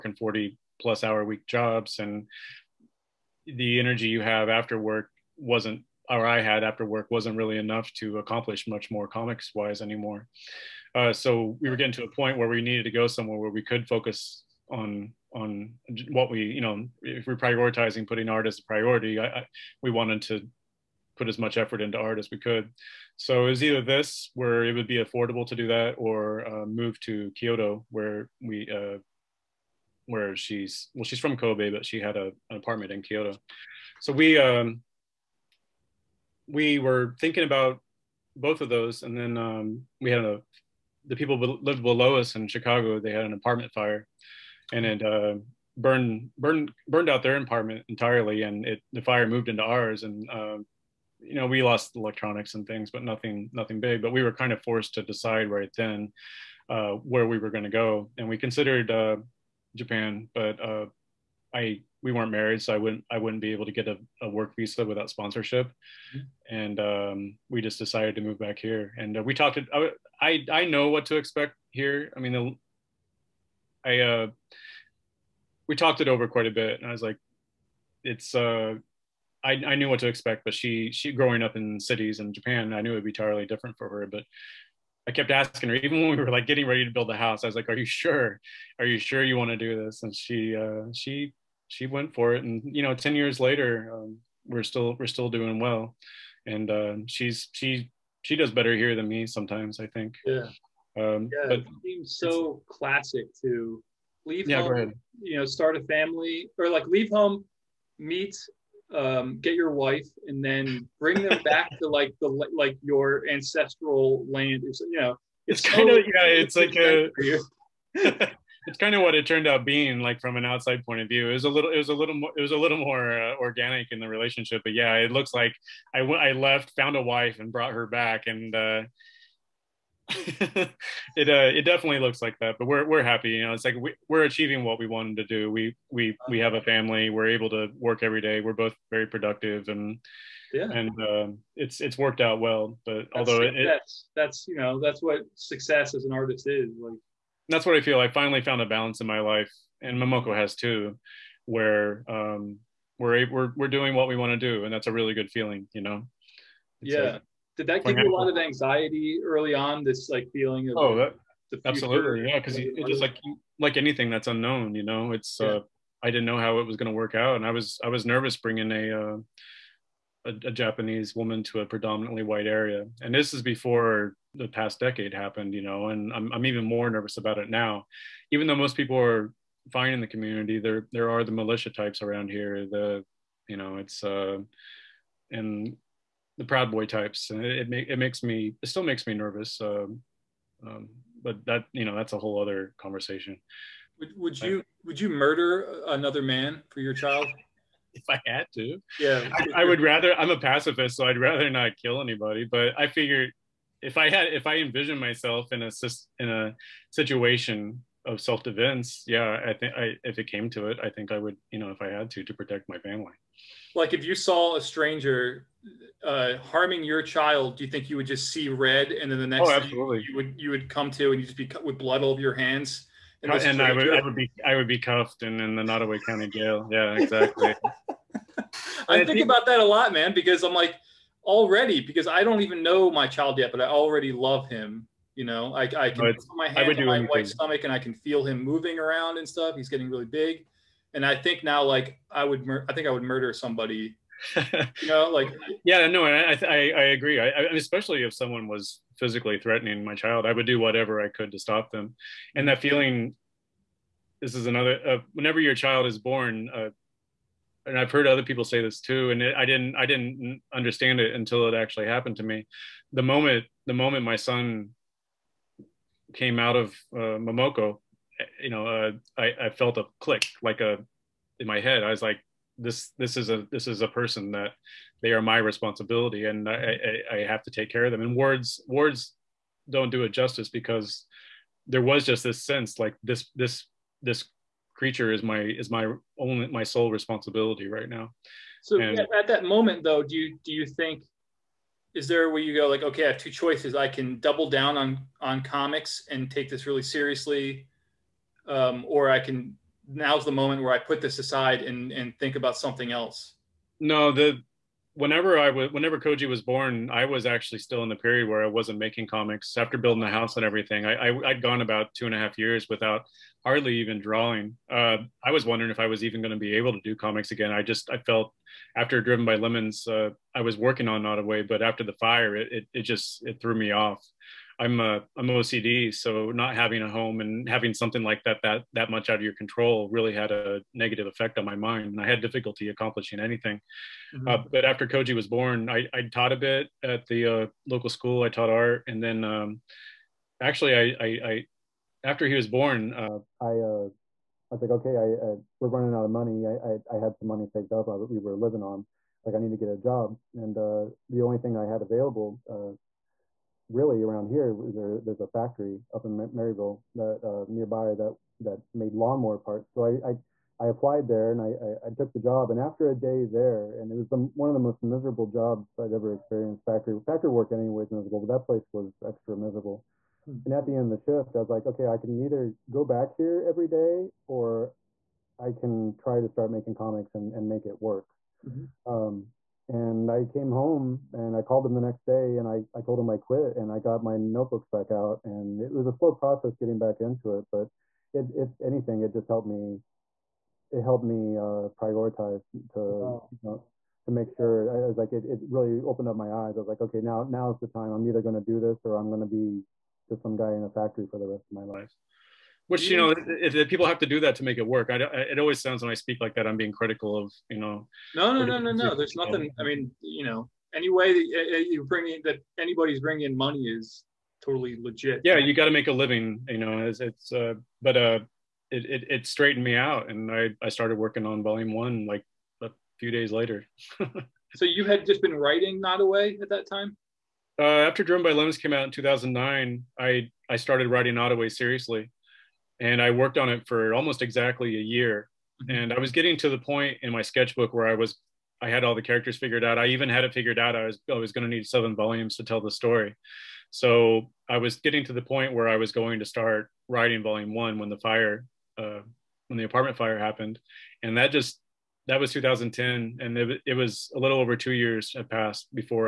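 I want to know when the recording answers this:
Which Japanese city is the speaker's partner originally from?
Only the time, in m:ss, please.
0:31.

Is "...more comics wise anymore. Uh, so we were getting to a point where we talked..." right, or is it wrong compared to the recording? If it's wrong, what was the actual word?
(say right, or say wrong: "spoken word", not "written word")
wrong: "needed", not "talked".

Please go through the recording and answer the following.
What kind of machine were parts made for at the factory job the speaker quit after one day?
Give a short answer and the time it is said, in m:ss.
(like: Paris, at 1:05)
lawnmower, at 5:58.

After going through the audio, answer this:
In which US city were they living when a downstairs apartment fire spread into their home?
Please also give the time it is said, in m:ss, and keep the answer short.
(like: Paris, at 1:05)
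Chicago, at 0:42.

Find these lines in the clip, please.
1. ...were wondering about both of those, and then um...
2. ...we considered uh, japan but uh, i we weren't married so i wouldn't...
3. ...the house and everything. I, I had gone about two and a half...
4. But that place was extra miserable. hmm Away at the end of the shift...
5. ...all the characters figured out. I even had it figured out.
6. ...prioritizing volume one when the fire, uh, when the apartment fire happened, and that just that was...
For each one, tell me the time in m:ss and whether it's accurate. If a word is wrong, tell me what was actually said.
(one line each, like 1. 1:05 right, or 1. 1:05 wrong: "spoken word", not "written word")
1. 0:36 wrong: "thinking", not "wondering"
2. 0:58 right
3. 5:10 right
4. 6:08 wrong: "And", not "Away"
5. 7:18 right
6. 7:26 wrong: "writing", not "prioritizing".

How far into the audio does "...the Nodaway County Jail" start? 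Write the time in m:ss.
3:45.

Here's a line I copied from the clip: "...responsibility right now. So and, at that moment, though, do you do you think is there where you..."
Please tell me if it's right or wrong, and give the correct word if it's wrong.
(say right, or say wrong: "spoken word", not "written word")
right.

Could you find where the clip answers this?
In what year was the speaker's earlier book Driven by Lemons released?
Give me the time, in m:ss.
7:08.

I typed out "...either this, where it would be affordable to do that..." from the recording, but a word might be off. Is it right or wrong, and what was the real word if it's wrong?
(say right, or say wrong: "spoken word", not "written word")
right.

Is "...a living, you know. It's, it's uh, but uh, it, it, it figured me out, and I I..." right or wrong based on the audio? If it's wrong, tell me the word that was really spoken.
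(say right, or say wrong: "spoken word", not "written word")
wrong: "straightened", not "figured".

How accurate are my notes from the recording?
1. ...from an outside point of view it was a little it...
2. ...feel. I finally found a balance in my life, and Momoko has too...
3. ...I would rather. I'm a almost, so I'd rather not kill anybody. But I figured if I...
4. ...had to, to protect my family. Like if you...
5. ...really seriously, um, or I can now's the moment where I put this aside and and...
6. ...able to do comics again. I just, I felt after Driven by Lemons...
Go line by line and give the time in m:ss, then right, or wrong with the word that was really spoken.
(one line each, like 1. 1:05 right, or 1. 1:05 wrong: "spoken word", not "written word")
1. 2:00 right
2. 2:27 right
3. 3:19 wrong: "pacifist", not "almost"
4. 3:31 right
5. 4:56 right
6. 5:16 right.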